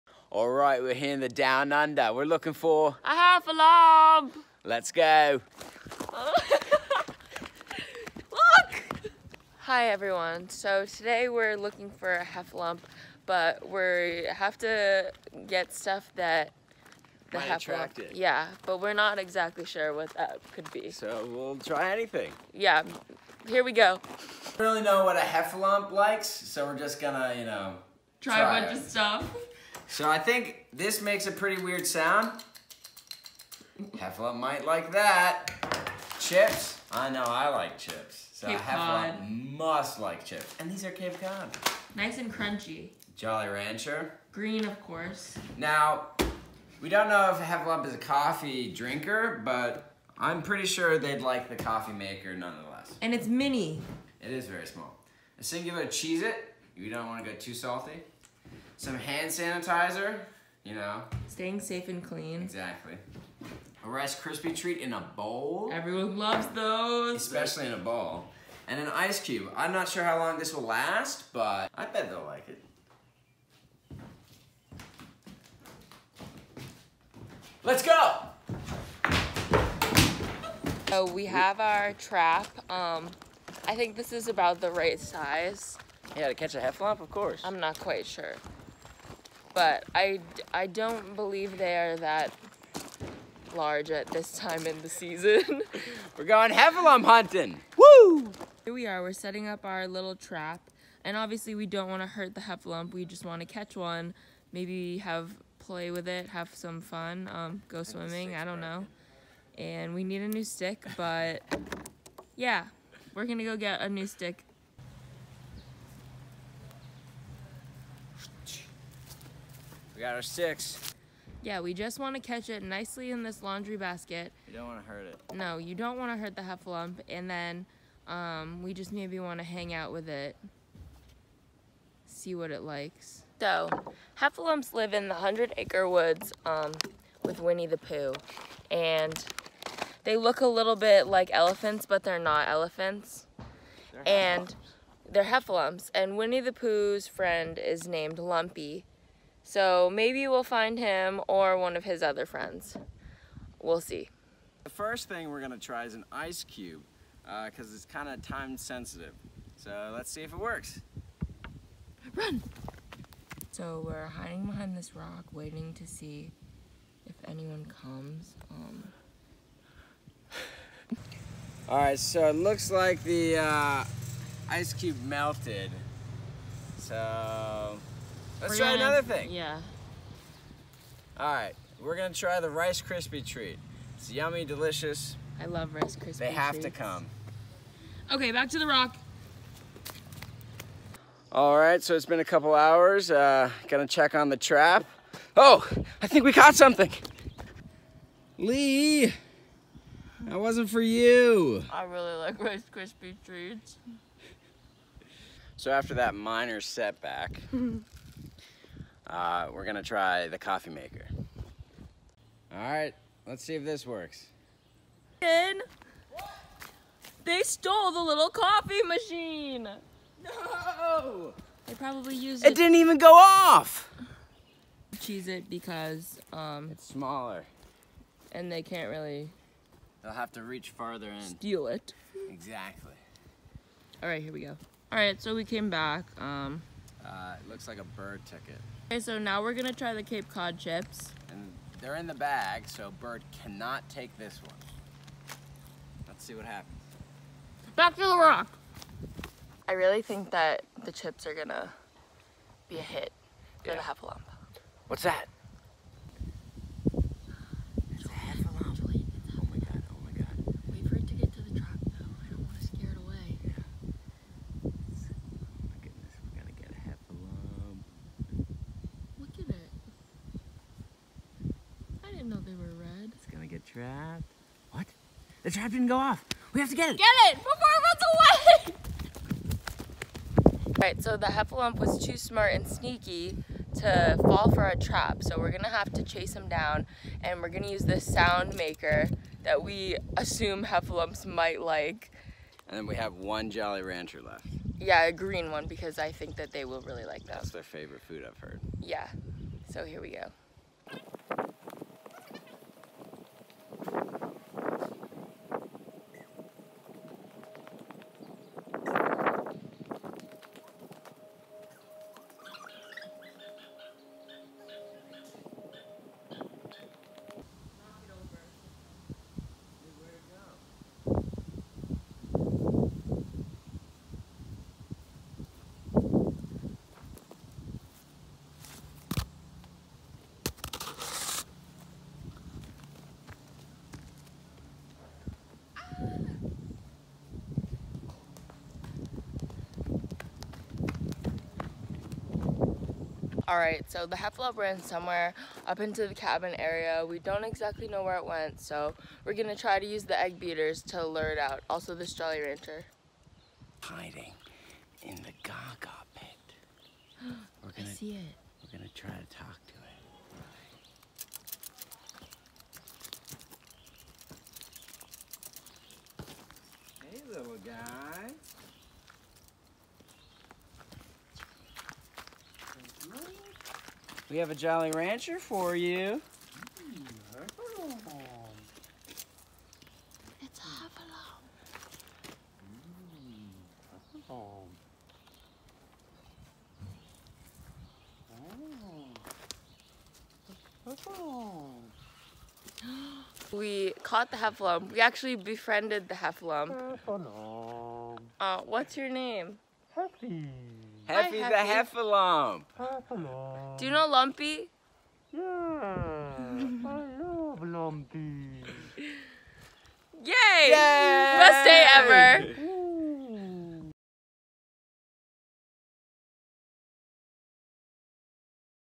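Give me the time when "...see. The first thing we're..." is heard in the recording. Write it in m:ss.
2:33.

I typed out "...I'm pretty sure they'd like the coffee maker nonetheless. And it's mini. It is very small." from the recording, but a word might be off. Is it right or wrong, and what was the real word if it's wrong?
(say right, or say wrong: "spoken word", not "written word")
right.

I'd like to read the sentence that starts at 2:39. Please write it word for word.
So let's see if it works.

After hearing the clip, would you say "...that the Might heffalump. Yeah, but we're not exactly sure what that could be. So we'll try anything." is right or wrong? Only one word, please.
right.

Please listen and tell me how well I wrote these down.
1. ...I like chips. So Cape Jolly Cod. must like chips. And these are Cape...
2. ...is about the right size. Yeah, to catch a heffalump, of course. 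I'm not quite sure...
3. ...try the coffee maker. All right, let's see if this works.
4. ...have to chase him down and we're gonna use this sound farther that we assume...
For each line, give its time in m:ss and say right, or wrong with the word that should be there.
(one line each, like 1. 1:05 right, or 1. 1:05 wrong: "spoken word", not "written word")
1. 0:37 wrong: "Hefla", not "Jolly"
2. 1:24 right
3. 3:29 right
4. 4:45 wrong: "maker", not "farther".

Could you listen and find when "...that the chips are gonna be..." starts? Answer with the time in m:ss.
4:10.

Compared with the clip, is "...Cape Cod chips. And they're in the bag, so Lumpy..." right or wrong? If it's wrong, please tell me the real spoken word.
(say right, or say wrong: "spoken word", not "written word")
wrong: "Bird", not "Lumpy".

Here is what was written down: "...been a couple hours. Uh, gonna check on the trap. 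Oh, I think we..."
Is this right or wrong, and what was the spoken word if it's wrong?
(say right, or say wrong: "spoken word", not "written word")
right.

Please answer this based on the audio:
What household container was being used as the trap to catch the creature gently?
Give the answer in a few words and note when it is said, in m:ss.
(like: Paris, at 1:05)
Laundry basket, at 2:03.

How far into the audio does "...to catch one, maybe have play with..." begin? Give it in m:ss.
1:43.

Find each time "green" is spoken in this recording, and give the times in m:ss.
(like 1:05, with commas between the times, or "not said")
0:44, 4:55.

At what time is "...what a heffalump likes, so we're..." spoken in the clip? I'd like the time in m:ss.
0:25.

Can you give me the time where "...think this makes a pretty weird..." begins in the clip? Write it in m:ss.
0:30.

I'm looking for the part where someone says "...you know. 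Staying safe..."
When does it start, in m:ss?
1:00.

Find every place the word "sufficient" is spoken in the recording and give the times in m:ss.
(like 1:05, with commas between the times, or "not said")
not said.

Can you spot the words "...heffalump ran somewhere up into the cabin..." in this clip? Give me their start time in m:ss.
5:44.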